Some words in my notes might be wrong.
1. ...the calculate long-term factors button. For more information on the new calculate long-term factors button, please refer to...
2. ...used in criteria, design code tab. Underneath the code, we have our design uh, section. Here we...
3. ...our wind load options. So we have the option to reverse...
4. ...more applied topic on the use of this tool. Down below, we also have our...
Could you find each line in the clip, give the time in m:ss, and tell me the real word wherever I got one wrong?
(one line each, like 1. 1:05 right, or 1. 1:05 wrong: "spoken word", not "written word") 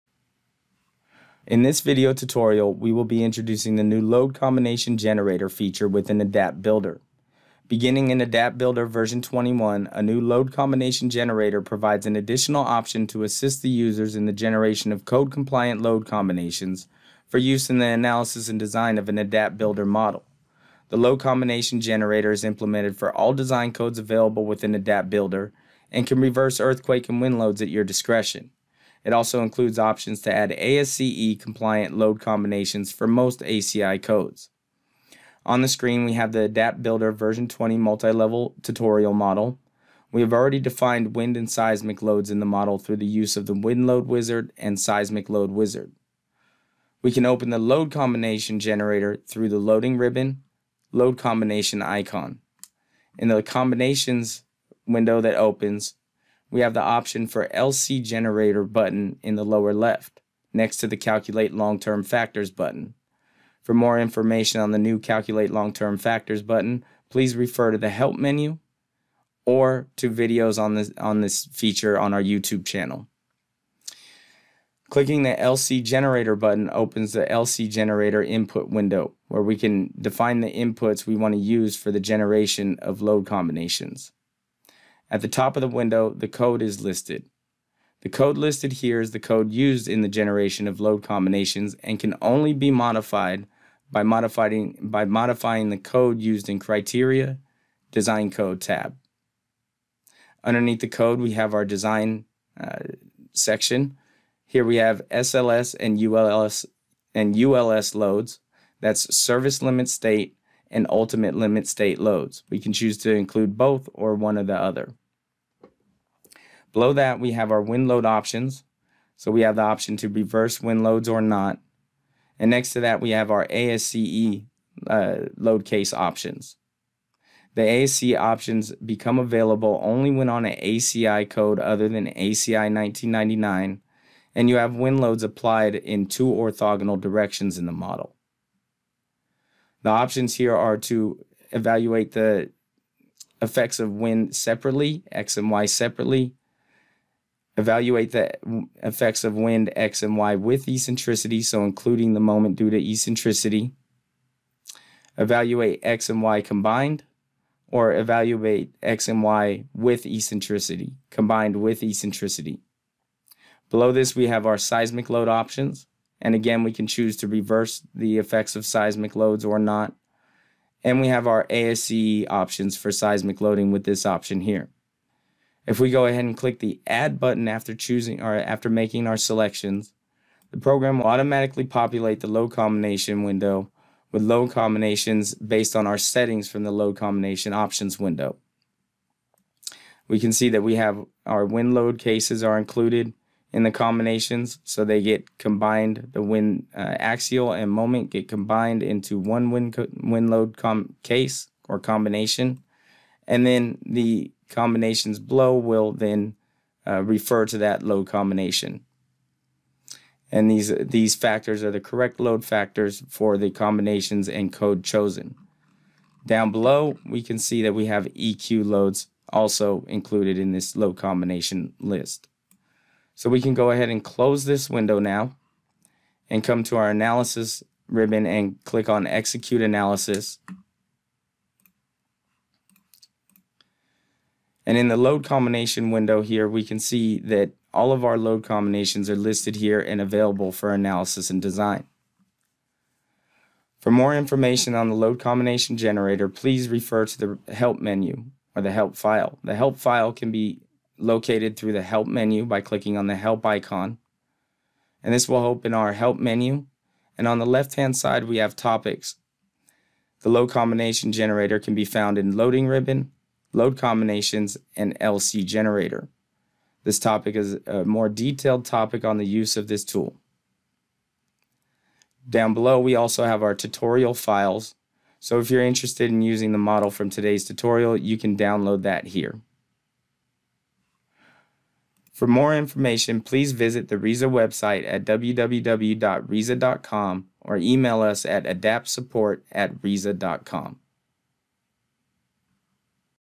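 1. 1:00 right
2. 1:36 right
3. 1:57 right
4. 4:27 wrong: "detailed", not "applied".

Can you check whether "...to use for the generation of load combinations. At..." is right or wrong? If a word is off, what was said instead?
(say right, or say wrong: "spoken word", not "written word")
right.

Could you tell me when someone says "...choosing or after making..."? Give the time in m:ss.
2:57.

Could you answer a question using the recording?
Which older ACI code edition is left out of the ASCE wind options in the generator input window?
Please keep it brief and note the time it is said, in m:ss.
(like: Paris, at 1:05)
ACI 1999, at 2:12.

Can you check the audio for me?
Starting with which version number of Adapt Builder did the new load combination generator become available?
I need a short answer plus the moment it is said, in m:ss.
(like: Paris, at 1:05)
21, at 0:08.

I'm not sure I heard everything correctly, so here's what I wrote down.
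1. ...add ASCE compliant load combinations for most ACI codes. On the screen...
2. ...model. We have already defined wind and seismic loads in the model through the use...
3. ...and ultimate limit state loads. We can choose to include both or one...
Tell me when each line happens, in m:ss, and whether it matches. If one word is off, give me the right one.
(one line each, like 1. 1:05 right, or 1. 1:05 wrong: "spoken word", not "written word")
1. 0:30 right
2. 0:39 right
3. 1:50 right.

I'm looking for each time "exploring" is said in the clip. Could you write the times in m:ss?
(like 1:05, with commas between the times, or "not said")
not said.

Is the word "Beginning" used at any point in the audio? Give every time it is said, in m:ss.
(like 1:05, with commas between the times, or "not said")
0:07.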